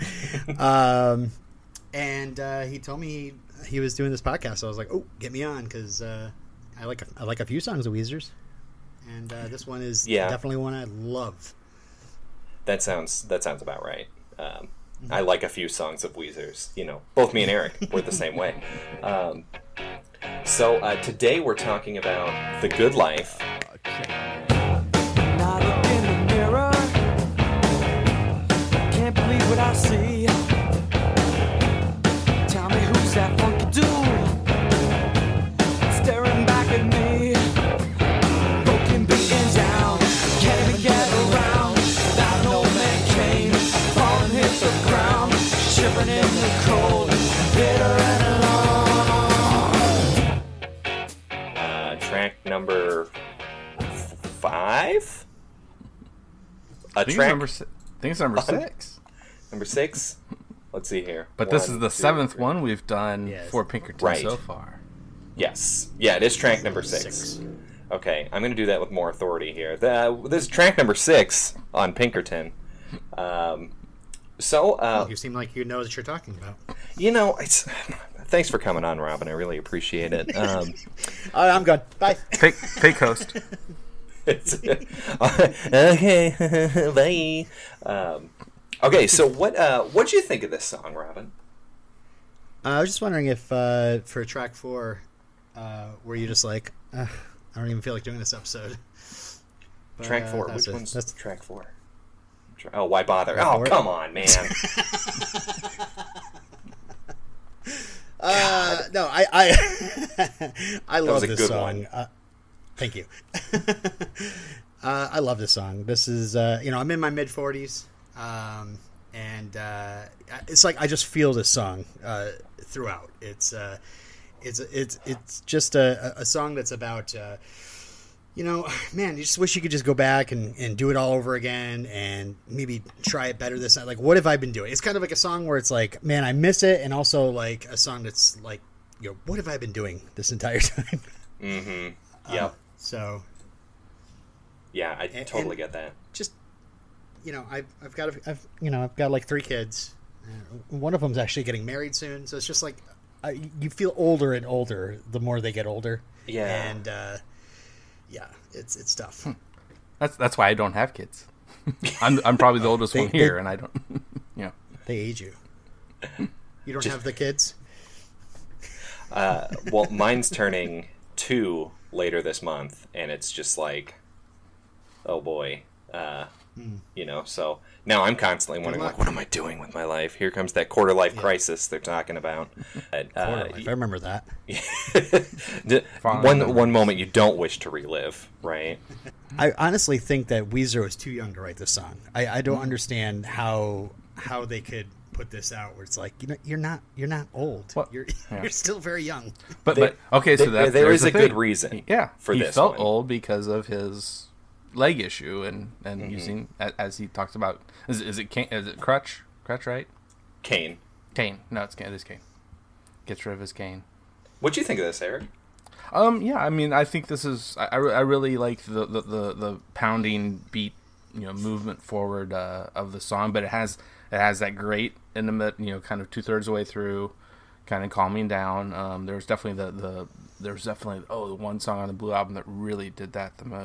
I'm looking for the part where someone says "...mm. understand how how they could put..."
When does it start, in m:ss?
3:12.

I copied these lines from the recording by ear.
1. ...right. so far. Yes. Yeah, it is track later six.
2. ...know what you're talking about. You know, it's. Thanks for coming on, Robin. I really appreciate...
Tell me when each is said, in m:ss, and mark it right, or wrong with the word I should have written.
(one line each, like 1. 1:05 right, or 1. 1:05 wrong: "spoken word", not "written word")
1. 1:04 wrong: "number", not "later"
2. 1:15 right.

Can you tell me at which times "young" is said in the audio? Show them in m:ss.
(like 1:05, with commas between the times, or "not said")
3:11, 3:19.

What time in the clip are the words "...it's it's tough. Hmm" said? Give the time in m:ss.
2:38.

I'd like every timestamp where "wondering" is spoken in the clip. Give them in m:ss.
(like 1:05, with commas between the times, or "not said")
1:33, 2:58.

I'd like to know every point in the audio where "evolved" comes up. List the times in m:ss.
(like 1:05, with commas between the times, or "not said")
not said.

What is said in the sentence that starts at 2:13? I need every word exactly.
Like, what have I been doing?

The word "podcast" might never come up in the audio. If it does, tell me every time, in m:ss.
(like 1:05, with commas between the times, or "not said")
0:04.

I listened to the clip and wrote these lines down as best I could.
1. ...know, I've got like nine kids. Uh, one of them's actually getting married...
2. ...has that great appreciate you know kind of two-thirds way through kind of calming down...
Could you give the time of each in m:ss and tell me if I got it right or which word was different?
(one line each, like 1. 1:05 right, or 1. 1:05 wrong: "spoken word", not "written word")
1. 2:28 wrong: "three", not "nine"
2. 3:44 wrong: "intimate", not "appreciate".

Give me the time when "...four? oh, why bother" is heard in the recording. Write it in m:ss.
1:41.